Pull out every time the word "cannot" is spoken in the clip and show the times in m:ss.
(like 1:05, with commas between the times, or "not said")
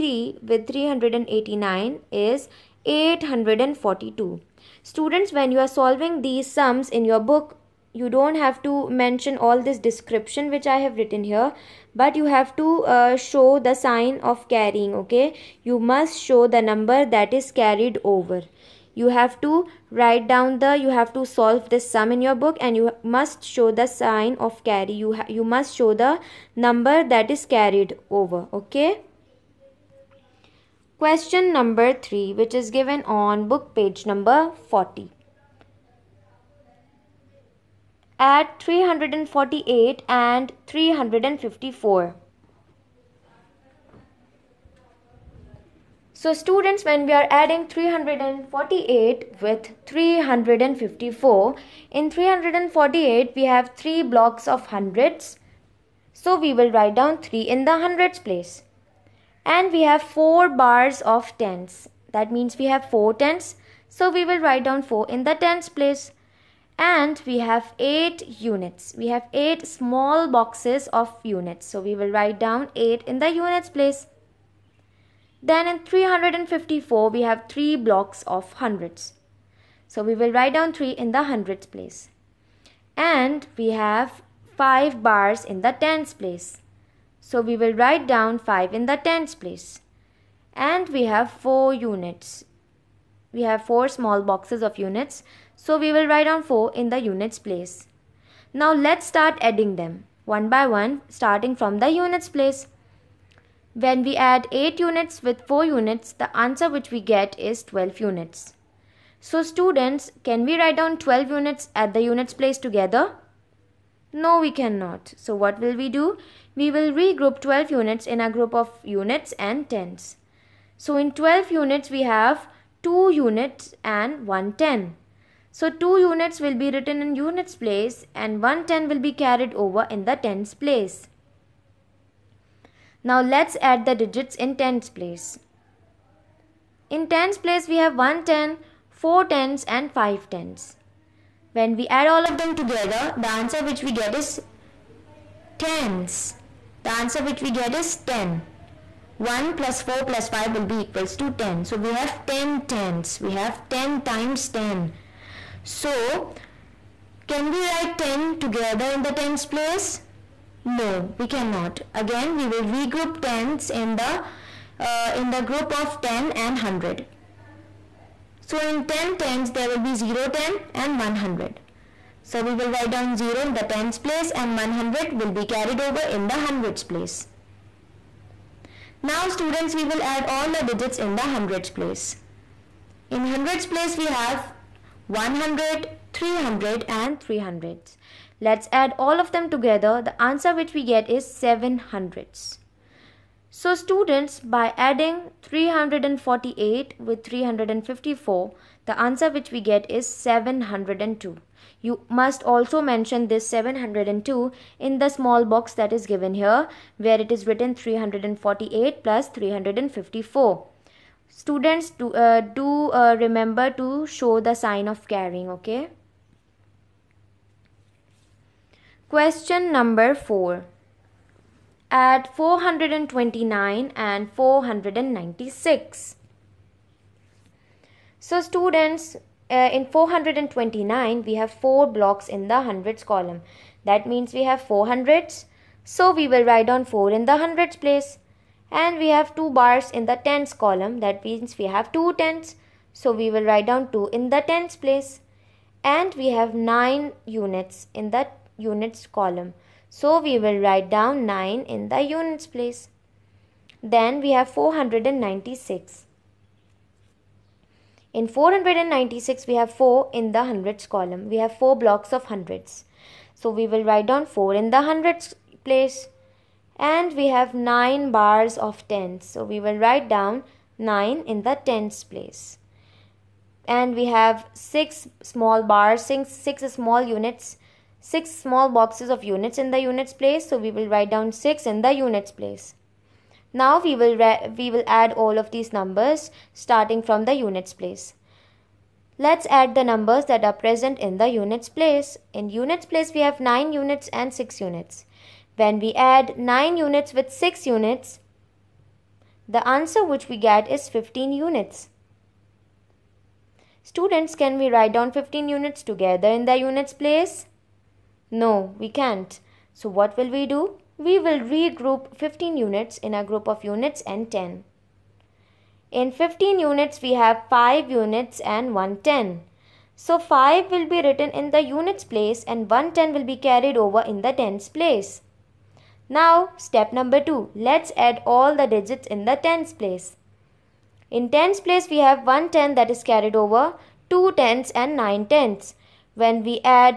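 1:54, 2:41.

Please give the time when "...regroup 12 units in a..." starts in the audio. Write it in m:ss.
1:56.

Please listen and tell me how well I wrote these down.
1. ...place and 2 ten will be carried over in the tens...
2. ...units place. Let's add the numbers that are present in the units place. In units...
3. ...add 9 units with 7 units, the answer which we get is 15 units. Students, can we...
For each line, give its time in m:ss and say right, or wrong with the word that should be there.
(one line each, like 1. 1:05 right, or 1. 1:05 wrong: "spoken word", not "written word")
1. 2:07 wrong: "1", not "2"
2. 4:47 right
3. 4:55 wrong: "6", not "7".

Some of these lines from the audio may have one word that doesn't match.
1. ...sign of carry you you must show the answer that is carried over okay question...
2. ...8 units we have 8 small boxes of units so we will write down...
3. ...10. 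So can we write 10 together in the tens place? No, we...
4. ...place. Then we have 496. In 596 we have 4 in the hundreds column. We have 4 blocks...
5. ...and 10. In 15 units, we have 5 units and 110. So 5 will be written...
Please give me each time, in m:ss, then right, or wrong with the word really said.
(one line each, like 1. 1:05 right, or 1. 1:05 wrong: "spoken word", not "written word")
1. 0:23 wrong: "number", not "answer"
2. 1:07 right
3. 2:34 right
4. 4:12 wrong: "496", not "596"
5. 5:14 right.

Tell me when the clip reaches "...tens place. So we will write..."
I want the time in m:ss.
1:25.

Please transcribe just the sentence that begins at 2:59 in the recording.
Now students, we will add all the digits in the hundreds place.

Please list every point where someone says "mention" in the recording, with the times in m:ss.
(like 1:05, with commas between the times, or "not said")
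0:08, 3:22.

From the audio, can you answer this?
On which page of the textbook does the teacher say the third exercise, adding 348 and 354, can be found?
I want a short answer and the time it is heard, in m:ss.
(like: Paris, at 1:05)
40, at 0:34.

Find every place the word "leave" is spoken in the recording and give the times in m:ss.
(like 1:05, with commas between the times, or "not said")
not said.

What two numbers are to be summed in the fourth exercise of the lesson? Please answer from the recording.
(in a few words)
429 and 496.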